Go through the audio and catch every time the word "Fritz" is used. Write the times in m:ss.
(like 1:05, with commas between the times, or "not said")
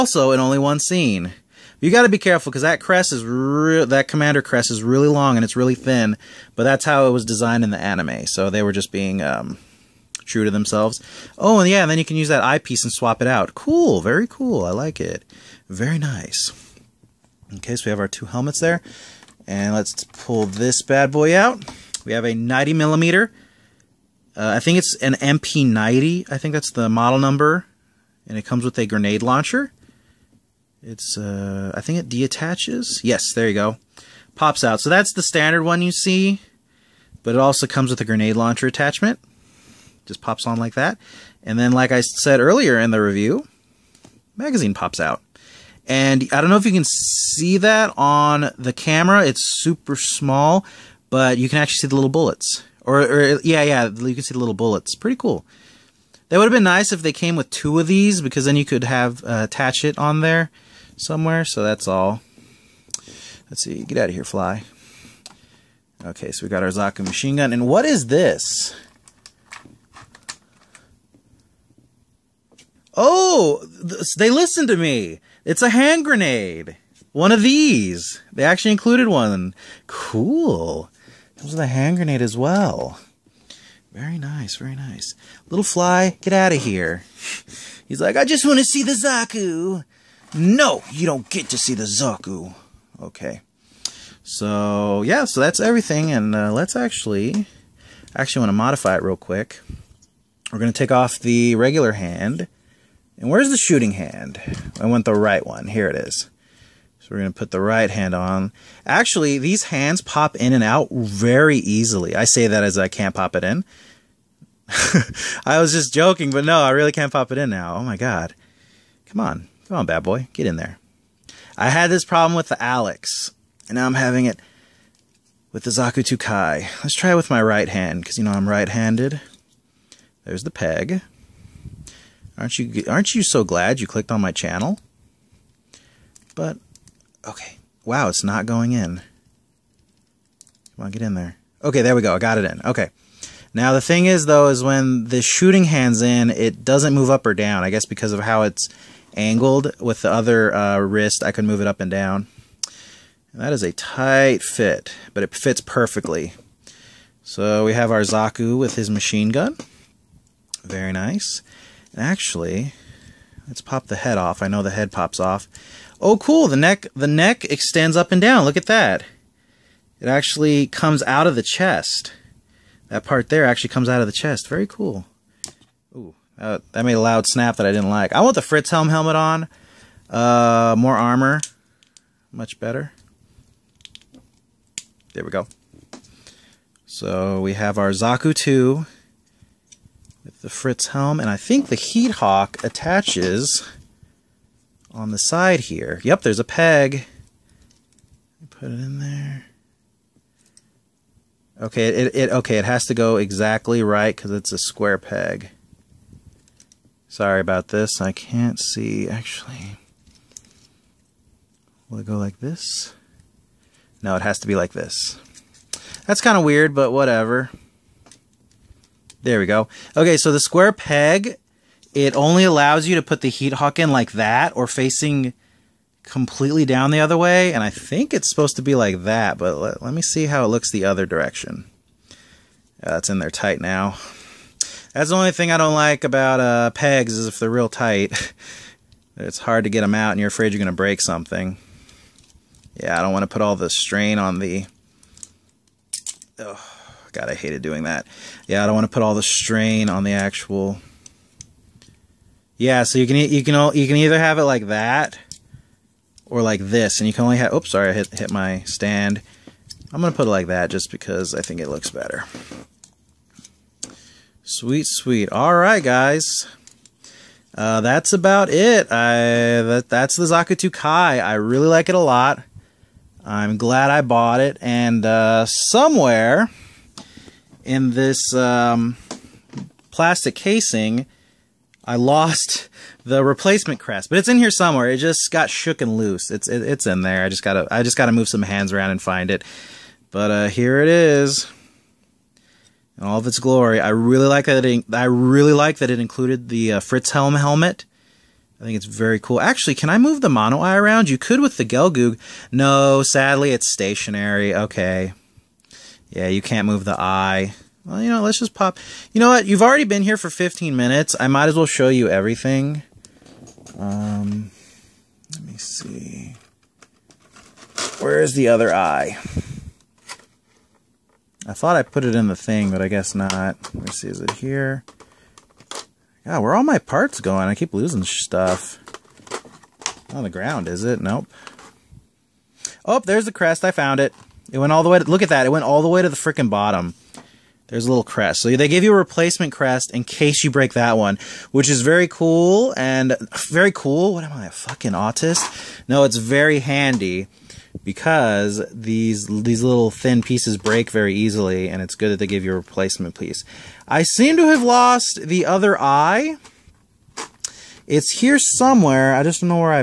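2:58, 3:10, 4:56.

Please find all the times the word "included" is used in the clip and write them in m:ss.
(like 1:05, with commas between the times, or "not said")
1:18, 4:55.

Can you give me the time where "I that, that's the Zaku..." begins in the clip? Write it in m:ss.
4:28.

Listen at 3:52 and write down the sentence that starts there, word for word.
That's uh, in there tight now.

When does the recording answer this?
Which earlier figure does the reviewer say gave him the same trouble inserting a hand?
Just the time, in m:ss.
2:02.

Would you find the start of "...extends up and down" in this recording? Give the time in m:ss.
2:47.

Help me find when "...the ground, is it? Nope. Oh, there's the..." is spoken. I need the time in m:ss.
5:30.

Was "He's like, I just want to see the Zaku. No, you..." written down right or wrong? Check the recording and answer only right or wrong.
right.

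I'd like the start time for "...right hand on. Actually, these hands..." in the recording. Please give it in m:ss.
1:47.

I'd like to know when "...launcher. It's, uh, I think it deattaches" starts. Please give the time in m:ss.
0:29.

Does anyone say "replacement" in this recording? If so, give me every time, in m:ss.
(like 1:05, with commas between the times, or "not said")
4:43, 5:38, 5:52.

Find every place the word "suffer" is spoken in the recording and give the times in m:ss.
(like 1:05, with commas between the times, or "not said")
not said.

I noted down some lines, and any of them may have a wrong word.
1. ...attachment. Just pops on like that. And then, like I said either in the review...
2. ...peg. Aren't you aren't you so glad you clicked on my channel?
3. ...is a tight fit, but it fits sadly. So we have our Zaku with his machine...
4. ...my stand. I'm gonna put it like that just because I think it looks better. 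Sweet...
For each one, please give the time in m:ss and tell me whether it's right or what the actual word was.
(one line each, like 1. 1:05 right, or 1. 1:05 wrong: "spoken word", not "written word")
1. 0:38 wrong: "earlier", not "either"
2. 2:10 right
3. 2:33 wrong: "perfectly", not "sadly"
4. 4:18 right.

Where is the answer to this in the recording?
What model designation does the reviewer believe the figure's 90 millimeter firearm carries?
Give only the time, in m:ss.
0:25.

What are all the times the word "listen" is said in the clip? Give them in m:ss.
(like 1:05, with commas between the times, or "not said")
1:14.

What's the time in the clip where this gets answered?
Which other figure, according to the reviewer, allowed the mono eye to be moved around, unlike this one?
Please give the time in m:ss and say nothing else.
5:01.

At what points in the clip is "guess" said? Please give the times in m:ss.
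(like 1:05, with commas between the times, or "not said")
2:27, 5:22.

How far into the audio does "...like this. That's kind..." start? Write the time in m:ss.
3:34.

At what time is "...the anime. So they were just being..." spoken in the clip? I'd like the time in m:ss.
0:07.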